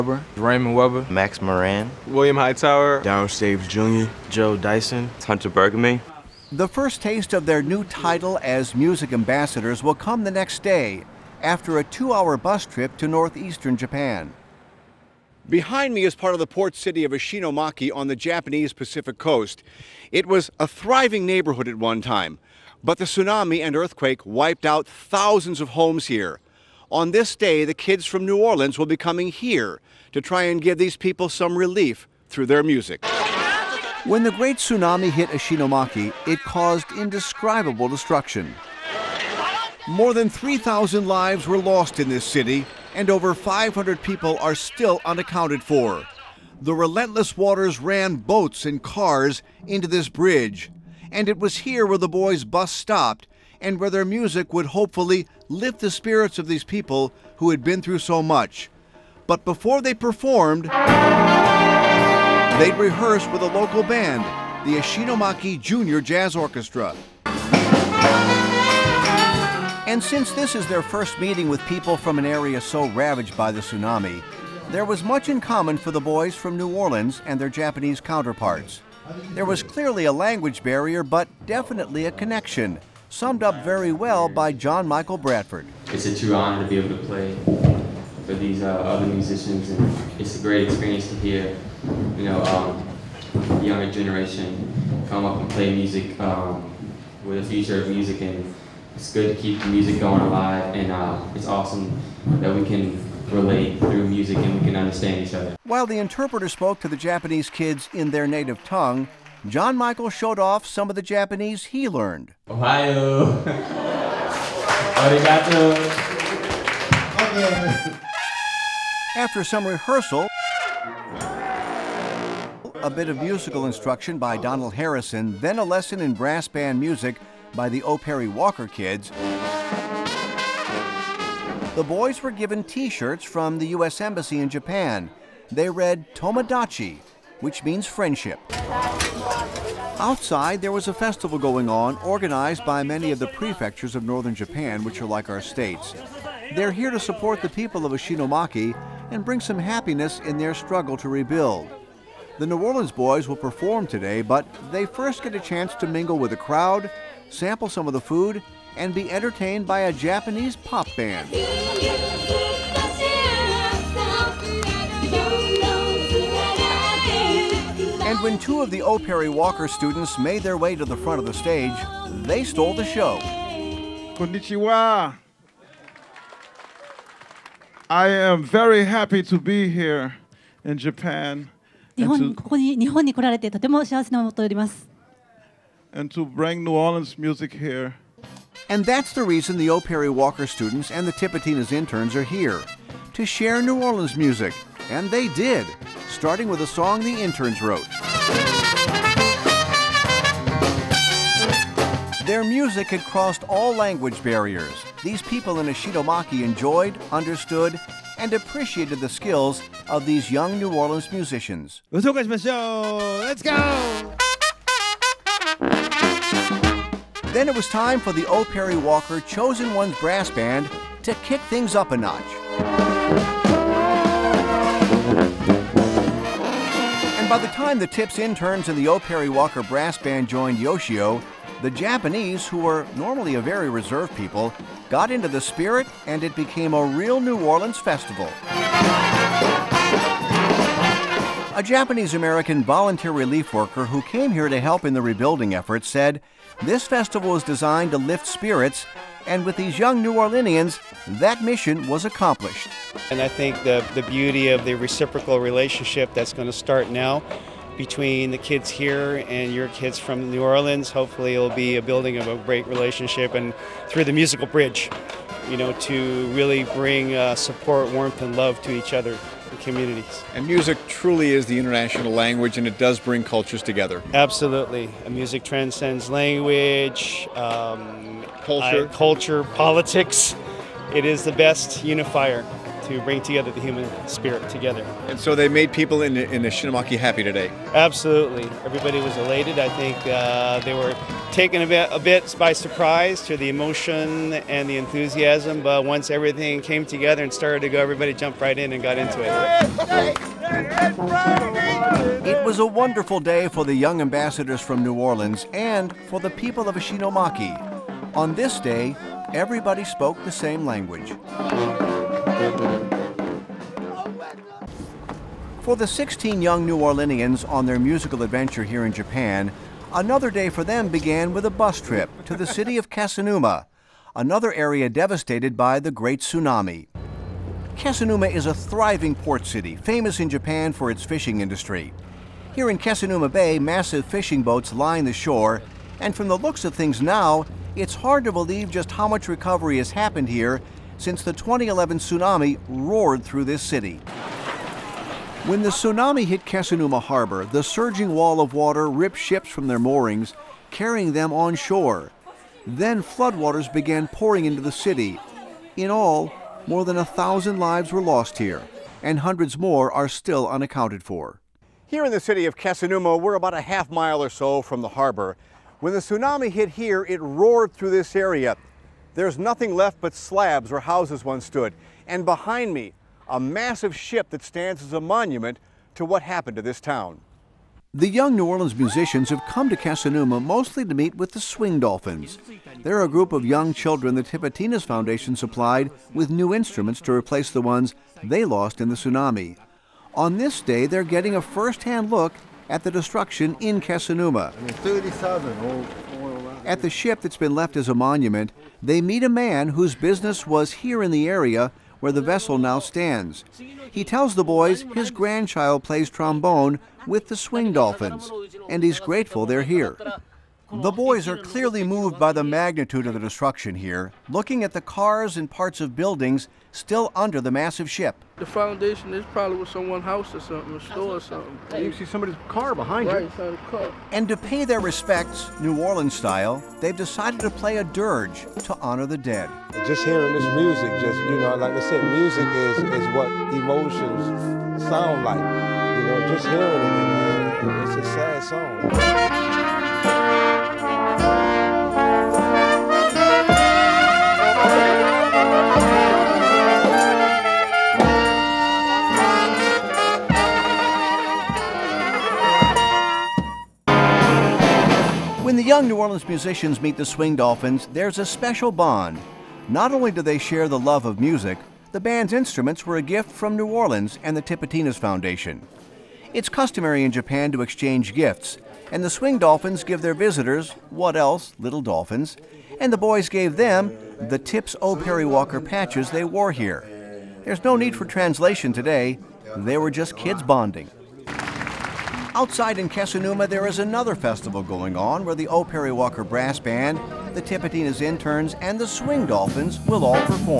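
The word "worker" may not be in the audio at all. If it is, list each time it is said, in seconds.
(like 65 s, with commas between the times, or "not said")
243 s.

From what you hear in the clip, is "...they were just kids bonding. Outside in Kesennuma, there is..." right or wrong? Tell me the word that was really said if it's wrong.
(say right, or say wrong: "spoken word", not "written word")
right.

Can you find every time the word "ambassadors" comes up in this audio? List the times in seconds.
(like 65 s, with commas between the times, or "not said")
9 s, 304 s.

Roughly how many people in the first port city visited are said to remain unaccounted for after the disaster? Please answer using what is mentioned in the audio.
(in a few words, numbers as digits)
500.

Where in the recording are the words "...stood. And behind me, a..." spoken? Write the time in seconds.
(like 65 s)
371 s.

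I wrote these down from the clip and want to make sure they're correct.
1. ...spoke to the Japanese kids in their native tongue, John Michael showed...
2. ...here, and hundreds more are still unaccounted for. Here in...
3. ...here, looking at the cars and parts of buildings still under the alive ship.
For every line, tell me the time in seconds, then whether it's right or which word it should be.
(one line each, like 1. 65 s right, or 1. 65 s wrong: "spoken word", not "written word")
1. 106 s right
2. 358 s right
3. 413 s wrong: "massive", not "alive".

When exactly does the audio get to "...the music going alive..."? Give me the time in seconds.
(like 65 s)
99 s.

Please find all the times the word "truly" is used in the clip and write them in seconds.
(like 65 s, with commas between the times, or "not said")
270 s.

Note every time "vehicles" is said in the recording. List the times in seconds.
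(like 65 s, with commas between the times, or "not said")
not said.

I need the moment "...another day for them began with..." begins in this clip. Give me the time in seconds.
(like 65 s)
319 s.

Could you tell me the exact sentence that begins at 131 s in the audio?
The boys were given t shirts from the U.S.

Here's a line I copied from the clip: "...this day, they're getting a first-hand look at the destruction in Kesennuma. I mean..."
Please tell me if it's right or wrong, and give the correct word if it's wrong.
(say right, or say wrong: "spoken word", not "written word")
right.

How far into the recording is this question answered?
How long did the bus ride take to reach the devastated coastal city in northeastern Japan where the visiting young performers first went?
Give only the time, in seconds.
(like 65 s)
11 s.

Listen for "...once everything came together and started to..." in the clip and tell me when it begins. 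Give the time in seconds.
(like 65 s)
295 s.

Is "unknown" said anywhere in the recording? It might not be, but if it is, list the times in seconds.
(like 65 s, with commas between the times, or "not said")
not said.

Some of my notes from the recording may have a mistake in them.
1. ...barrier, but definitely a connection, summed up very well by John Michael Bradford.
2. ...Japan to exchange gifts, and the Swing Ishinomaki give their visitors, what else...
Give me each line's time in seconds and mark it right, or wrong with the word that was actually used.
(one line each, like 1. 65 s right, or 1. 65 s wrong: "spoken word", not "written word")
1. 80 s right
2. 467 s wrong: "Dolphins", not "Ishinomaki".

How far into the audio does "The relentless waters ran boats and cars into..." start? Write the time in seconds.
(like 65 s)
46 s.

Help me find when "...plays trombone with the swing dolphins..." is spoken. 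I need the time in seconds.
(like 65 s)
405 s.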